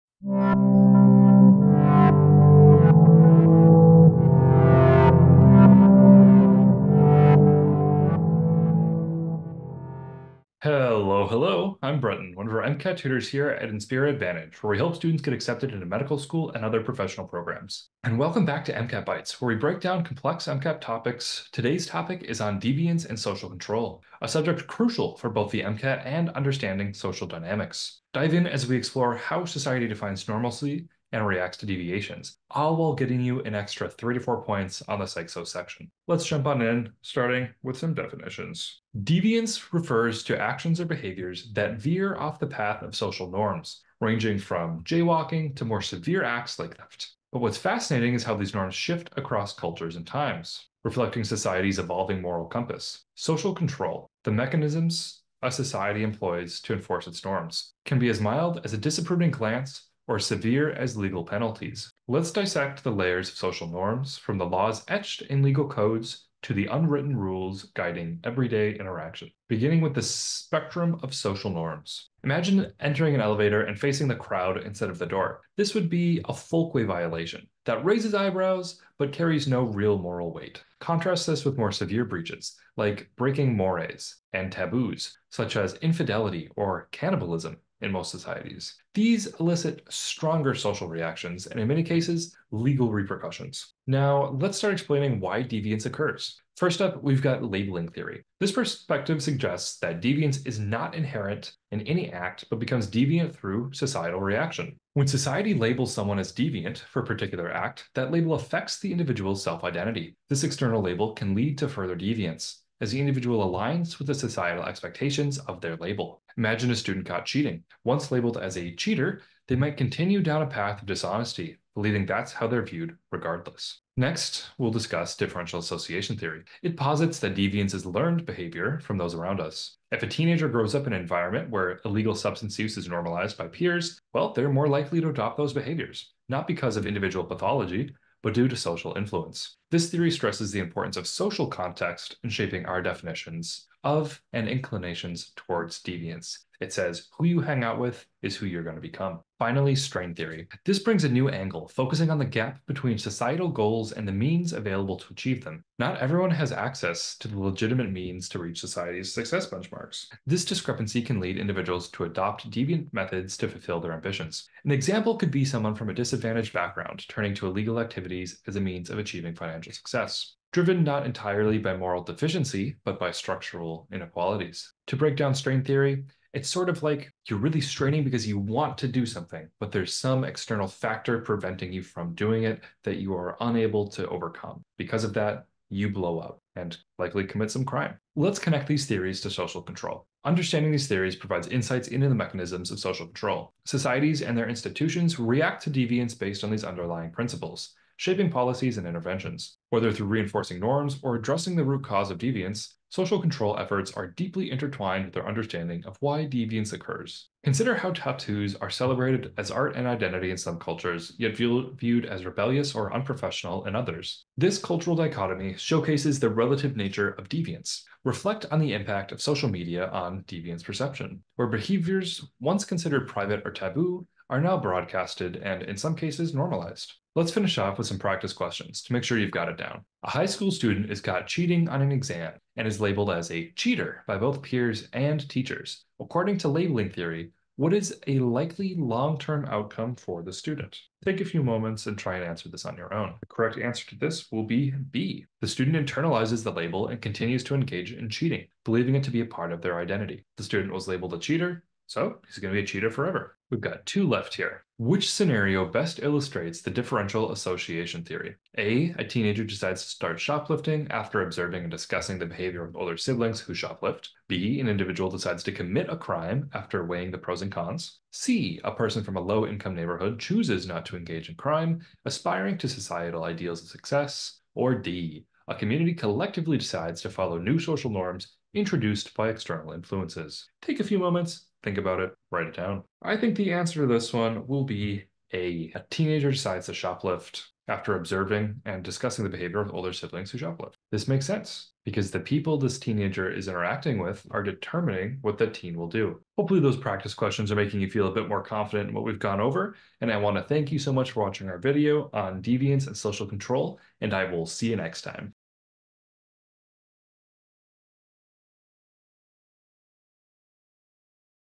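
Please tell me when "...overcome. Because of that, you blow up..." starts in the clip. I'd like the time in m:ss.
3:04.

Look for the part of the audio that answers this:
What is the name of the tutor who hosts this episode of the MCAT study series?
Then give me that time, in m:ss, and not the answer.
0:11.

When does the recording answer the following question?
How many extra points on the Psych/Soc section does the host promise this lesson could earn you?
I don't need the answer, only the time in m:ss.
0:33.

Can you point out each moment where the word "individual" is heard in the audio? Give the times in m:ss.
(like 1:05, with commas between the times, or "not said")
1:48, 1:52, 2:16, 2:41, 4:24.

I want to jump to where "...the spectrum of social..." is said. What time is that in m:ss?
1:09.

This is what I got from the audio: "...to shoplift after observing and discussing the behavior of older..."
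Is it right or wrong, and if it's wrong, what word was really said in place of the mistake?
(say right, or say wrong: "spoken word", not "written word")
right.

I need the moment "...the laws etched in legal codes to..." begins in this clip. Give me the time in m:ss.
1:04.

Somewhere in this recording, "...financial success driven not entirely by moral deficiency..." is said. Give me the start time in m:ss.
2:49.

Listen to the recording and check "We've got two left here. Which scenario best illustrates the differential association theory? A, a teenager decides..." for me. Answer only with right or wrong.
right.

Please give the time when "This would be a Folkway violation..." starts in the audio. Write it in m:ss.
1:15.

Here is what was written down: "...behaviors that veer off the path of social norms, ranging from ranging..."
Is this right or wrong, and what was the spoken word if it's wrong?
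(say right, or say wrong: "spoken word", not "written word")
wrong: "jaywalking", not "ranging".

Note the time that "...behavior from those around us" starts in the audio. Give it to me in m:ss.
2:08.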